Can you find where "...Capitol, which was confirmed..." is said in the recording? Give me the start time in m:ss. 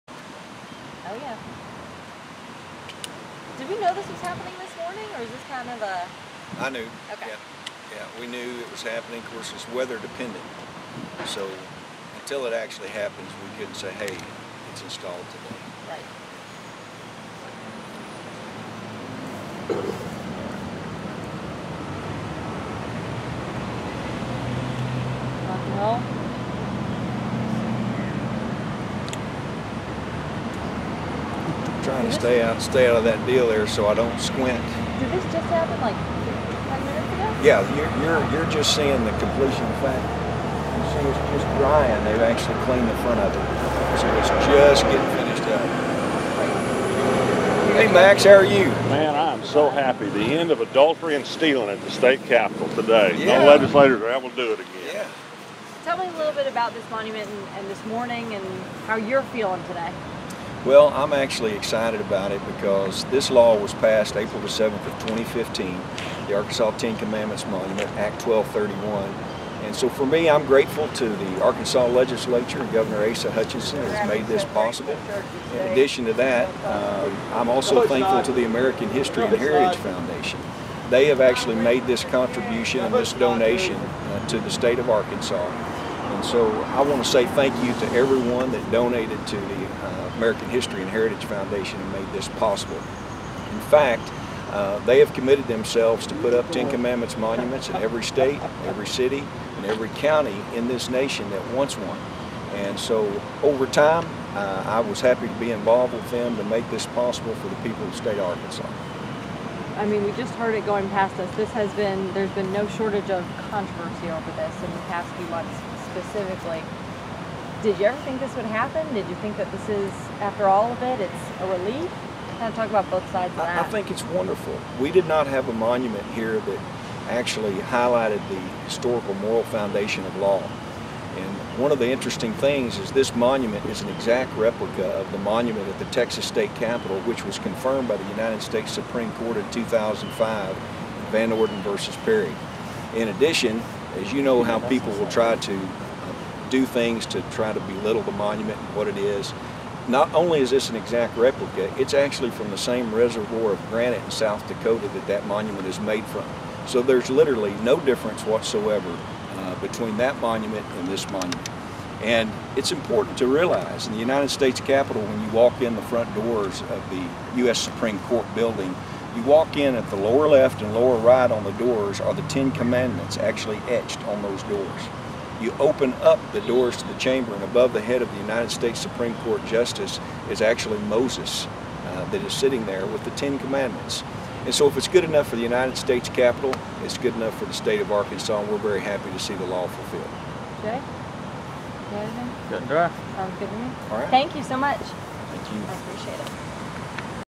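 2:16.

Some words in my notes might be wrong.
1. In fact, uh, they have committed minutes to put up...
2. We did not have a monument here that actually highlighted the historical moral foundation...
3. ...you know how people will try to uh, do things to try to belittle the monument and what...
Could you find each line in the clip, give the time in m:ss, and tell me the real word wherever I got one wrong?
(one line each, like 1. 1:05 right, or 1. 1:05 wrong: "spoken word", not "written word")
1. 1:32 wrong: "themselves", not "minutes"
2. 2:04 right
3. 2:24 right.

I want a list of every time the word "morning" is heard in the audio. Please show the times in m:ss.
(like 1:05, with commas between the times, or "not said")
0:04, 0:57.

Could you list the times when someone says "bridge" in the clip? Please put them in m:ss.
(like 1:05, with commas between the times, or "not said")
not said.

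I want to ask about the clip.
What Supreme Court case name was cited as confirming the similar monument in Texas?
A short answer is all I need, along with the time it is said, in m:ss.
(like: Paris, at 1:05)
Van Orden versus Perry, at 2:21.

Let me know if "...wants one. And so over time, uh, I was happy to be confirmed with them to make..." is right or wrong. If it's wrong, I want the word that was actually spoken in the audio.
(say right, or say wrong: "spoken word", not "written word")
wrong: "involved", not "confirmed".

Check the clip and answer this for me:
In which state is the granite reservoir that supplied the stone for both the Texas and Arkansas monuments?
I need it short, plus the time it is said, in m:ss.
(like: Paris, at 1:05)
South Dakota, at 2:34.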